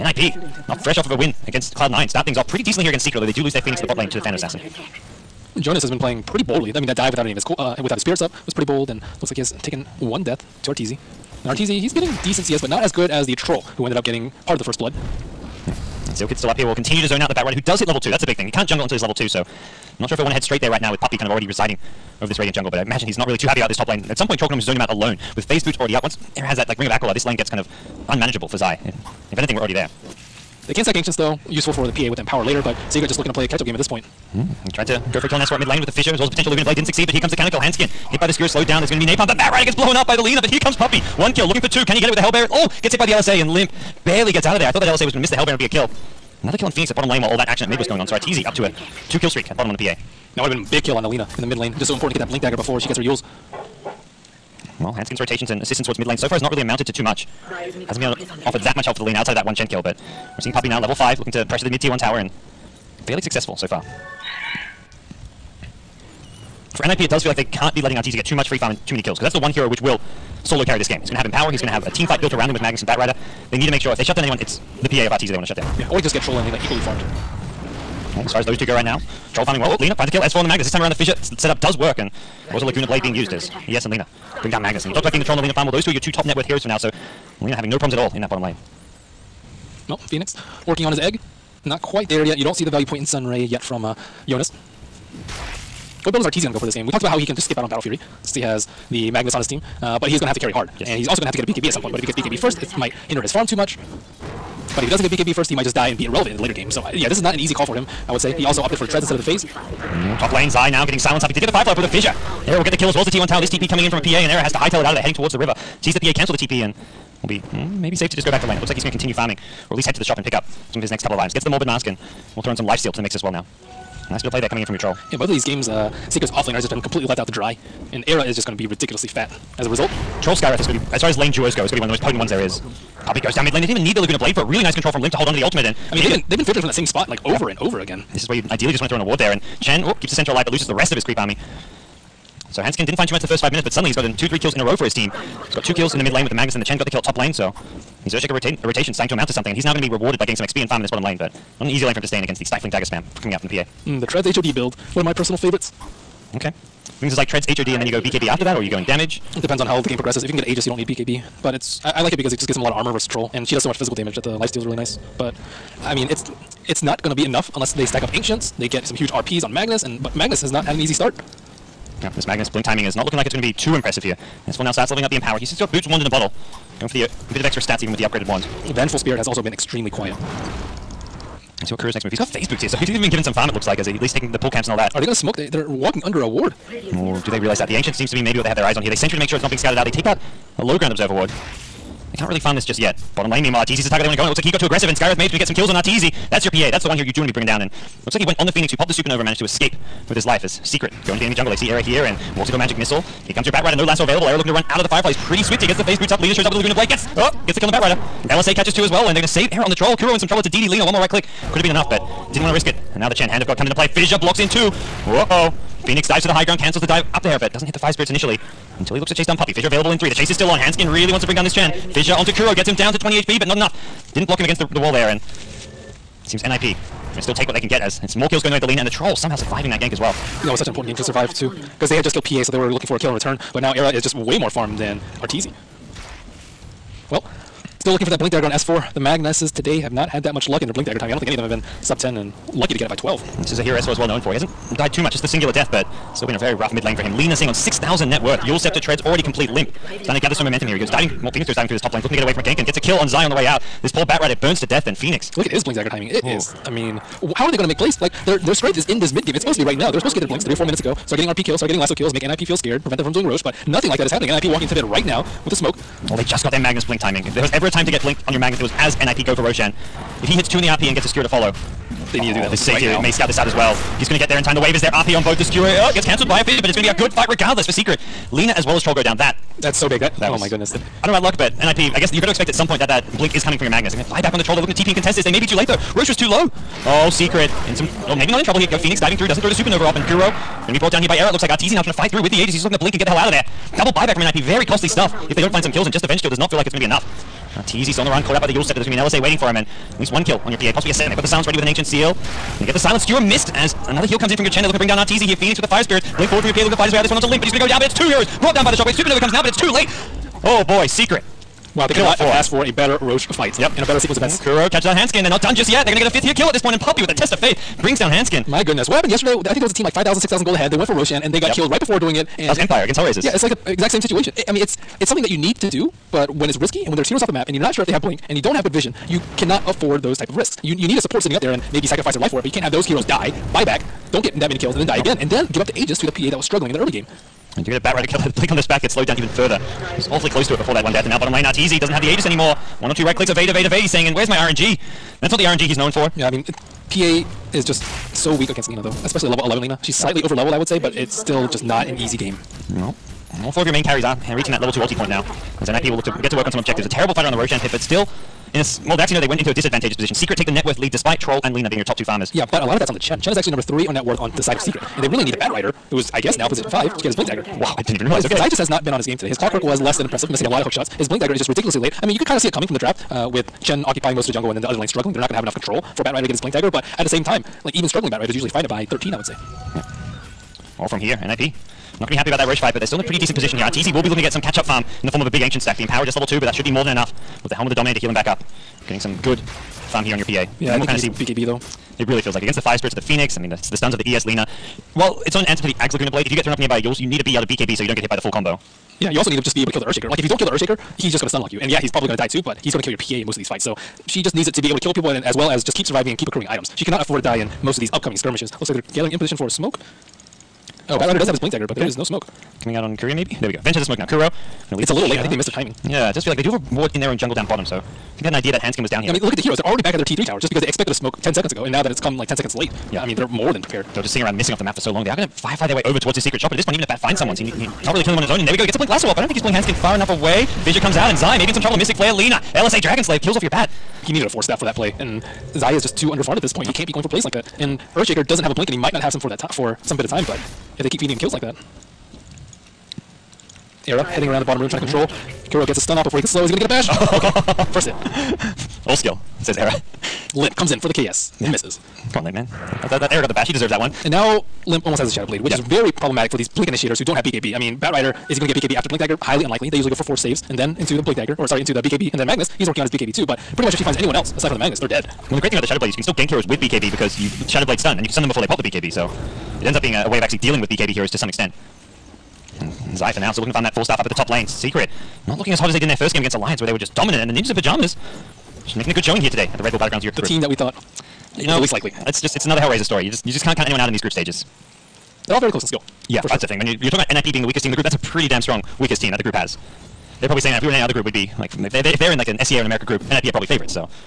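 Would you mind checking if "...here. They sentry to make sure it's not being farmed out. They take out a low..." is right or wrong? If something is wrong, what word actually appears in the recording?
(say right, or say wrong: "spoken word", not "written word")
wrong: "scattered", not "farmed".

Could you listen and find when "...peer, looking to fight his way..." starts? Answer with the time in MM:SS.
05:06.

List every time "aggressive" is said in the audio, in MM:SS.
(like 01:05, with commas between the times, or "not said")
03:14.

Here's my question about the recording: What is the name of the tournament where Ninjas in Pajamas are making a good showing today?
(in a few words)
Red Bull Battlegrounds Europe.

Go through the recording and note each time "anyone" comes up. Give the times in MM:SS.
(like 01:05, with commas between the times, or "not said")
01:14, 07:43, 08:03.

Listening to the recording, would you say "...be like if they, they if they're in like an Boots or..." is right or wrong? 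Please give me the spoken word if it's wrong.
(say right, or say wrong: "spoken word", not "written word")
wrong: "SEA", not "Boots".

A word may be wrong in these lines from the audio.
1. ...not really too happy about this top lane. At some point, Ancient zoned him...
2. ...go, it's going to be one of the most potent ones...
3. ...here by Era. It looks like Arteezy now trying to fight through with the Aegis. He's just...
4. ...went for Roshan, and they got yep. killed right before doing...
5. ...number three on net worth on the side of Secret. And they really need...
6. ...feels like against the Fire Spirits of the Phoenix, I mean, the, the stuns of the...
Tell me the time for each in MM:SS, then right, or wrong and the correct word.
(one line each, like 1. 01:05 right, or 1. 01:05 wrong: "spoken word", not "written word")
1. 00:23 wrong: "Trollknome", not "Ancient"
2. 02:11 right
3. 04:51 right
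4. 05:20 right
5. 06:03 right
6. 06:32 right.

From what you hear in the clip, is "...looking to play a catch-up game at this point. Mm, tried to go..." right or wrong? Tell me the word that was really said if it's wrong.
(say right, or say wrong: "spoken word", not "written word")
right.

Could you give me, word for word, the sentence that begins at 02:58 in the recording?
Vengeful Spirit has also been extremely quiet.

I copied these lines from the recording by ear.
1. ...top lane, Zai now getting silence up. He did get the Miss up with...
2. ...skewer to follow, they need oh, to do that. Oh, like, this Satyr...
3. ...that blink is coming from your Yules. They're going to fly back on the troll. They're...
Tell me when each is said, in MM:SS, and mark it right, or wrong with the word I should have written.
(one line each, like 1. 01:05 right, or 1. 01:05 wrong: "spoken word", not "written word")
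1. 01:50 wrong: "Firefly", not "Miss"
2. 04:31 right
3. 04:42 wrong: "Magnus", not "Yules".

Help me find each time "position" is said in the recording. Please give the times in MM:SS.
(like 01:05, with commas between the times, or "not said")
05:59, 06:06, 06:23, 06:49.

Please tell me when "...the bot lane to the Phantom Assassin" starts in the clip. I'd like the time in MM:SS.
00:03.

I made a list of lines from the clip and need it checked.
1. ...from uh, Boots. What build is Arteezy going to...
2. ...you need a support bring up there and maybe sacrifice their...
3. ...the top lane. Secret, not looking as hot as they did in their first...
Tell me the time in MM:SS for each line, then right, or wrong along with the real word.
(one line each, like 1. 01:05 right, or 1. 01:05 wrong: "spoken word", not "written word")
1. 01:33 wrong: "Jonas", not "Boots"
2. 05:30 wrong: "sitting", not "bring"
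3. 07:54 right.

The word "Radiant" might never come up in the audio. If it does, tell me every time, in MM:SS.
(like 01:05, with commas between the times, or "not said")
00:22.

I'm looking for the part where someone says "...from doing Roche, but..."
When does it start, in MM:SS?
04:23.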